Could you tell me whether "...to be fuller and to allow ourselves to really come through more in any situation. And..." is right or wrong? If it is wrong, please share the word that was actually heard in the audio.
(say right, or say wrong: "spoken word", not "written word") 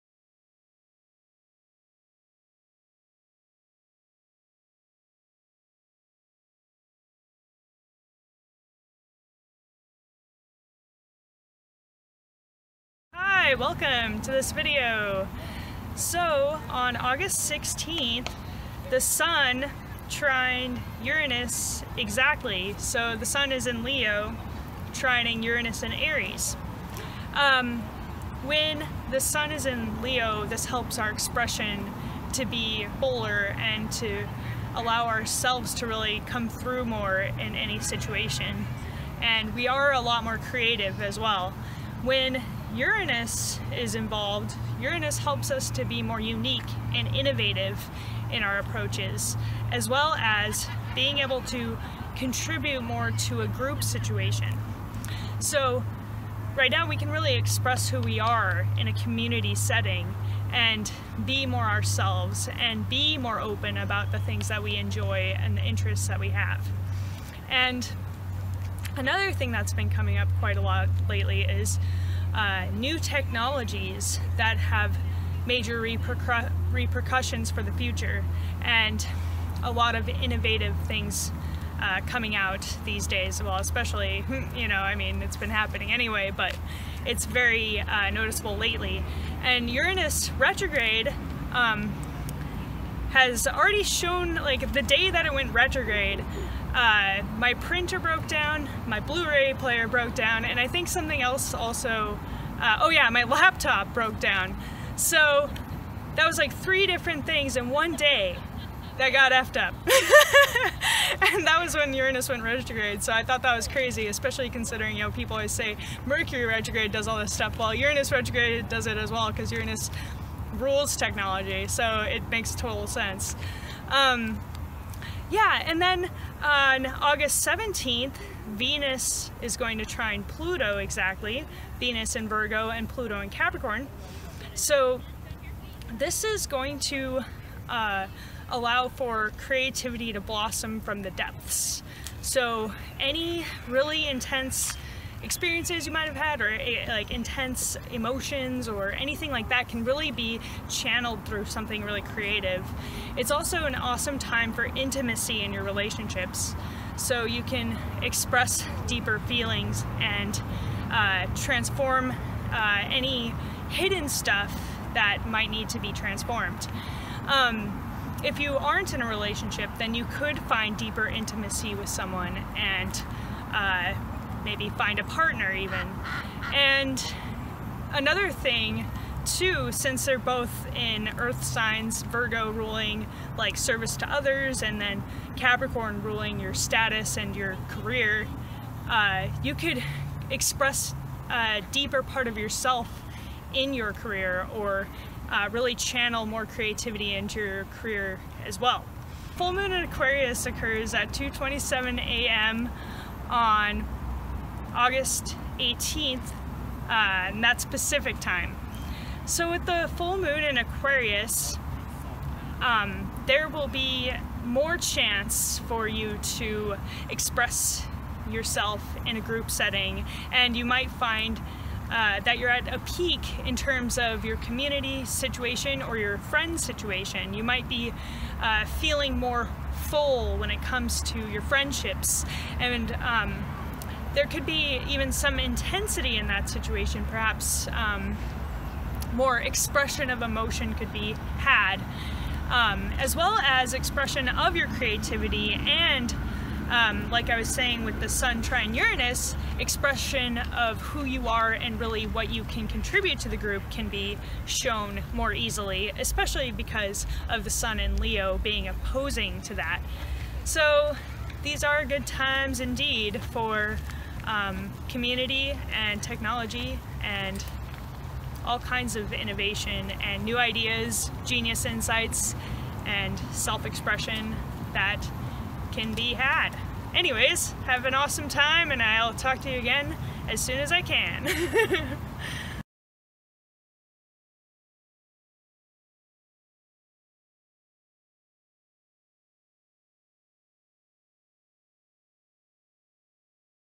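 right.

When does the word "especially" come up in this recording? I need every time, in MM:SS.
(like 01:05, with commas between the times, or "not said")
01:23, 01:54, 04:15.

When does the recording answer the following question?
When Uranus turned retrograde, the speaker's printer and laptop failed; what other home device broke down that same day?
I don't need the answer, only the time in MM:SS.
01:39.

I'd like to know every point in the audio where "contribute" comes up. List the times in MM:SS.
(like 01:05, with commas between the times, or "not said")
00:52, 04:12.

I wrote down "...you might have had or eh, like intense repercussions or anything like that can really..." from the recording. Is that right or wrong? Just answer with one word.
wrong.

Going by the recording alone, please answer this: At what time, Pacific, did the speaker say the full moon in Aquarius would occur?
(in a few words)
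2:27 a.m.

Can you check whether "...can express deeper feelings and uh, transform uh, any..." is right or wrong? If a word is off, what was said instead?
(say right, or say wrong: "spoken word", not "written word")
right.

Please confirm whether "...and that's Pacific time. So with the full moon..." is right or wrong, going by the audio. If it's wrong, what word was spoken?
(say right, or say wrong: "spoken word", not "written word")
right.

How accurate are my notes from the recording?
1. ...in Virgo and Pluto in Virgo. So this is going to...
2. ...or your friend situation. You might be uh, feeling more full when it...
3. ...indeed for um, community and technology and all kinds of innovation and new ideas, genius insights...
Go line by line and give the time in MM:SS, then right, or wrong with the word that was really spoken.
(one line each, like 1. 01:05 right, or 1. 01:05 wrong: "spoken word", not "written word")
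1. 02:12 wrong: "Capricorn", not "Virgo"
2. 03:45 right
3. 04:22 right.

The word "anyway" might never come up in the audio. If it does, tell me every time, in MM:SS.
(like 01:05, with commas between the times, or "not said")
01:25, 04:36.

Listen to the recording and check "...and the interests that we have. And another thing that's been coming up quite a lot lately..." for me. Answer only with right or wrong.
right.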